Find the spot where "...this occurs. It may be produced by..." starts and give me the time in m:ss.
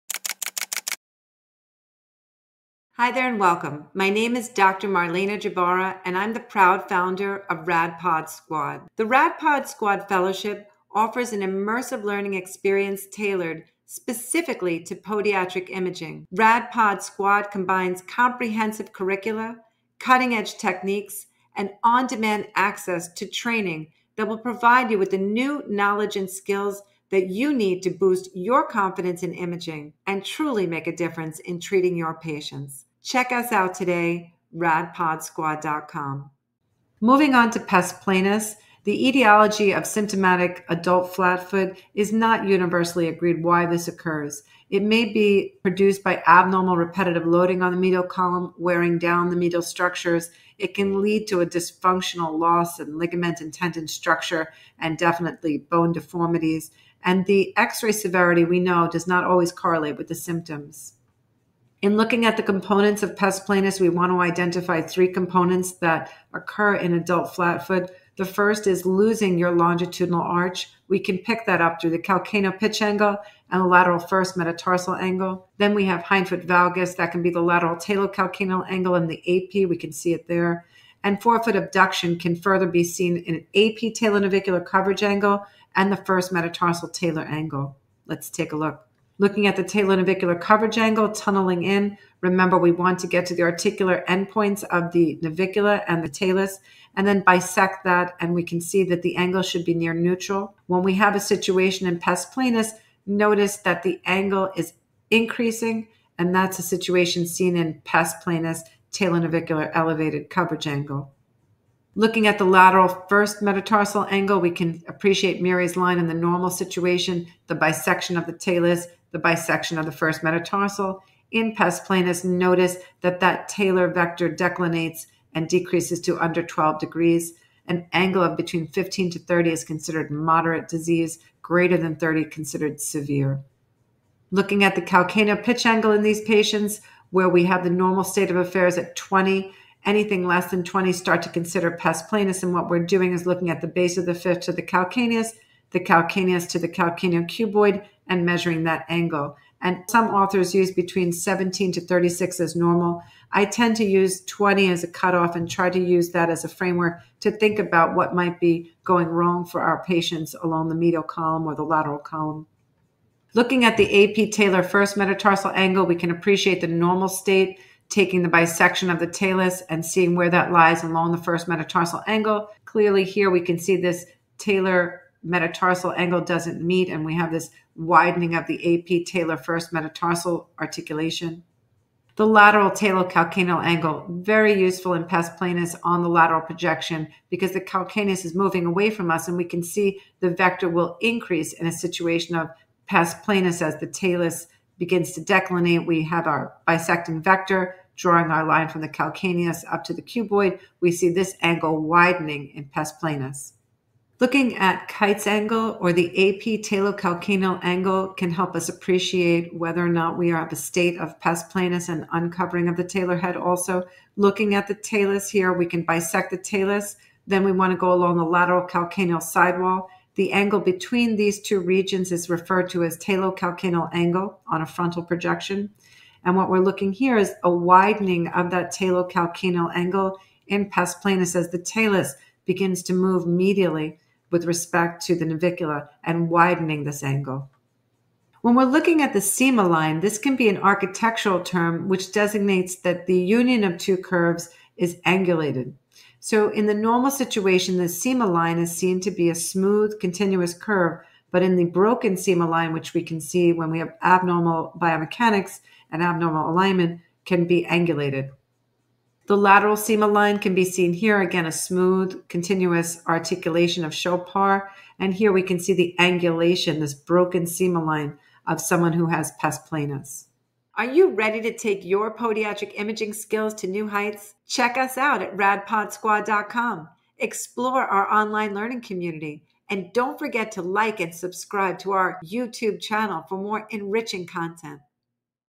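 0:43.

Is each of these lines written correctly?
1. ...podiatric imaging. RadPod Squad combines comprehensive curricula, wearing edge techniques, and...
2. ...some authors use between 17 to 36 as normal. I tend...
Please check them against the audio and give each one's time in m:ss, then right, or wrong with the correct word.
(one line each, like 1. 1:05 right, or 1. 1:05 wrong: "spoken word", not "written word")
1. 0:14 wrong: "cutting", not "wearing"
2. 2:29 right.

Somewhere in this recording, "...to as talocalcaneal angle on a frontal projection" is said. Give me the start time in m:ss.
3:42.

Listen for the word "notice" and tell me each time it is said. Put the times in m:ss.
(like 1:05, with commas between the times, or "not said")
1:43, 2:02.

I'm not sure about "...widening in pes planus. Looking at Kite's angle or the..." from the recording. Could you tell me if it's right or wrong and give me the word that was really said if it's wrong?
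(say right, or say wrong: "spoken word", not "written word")
right.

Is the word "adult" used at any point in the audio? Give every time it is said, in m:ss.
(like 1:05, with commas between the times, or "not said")
0:40, 1:06.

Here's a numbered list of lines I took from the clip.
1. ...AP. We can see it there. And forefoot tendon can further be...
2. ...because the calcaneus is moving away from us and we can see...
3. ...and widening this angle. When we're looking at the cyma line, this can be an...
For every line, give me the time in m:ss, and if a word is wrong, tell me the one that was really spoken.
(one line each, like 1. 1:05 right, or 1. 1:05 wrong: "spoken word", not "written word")
1. 1:19 wrong: "abduction", not "tendon"
2. 3:07 right
3. 3:56 right.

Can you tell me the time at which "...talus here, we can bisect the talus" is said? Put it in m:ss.
3:34.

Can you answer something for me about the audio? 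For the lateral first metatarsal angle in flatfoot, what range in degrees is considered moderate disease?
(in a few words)
15 to 30.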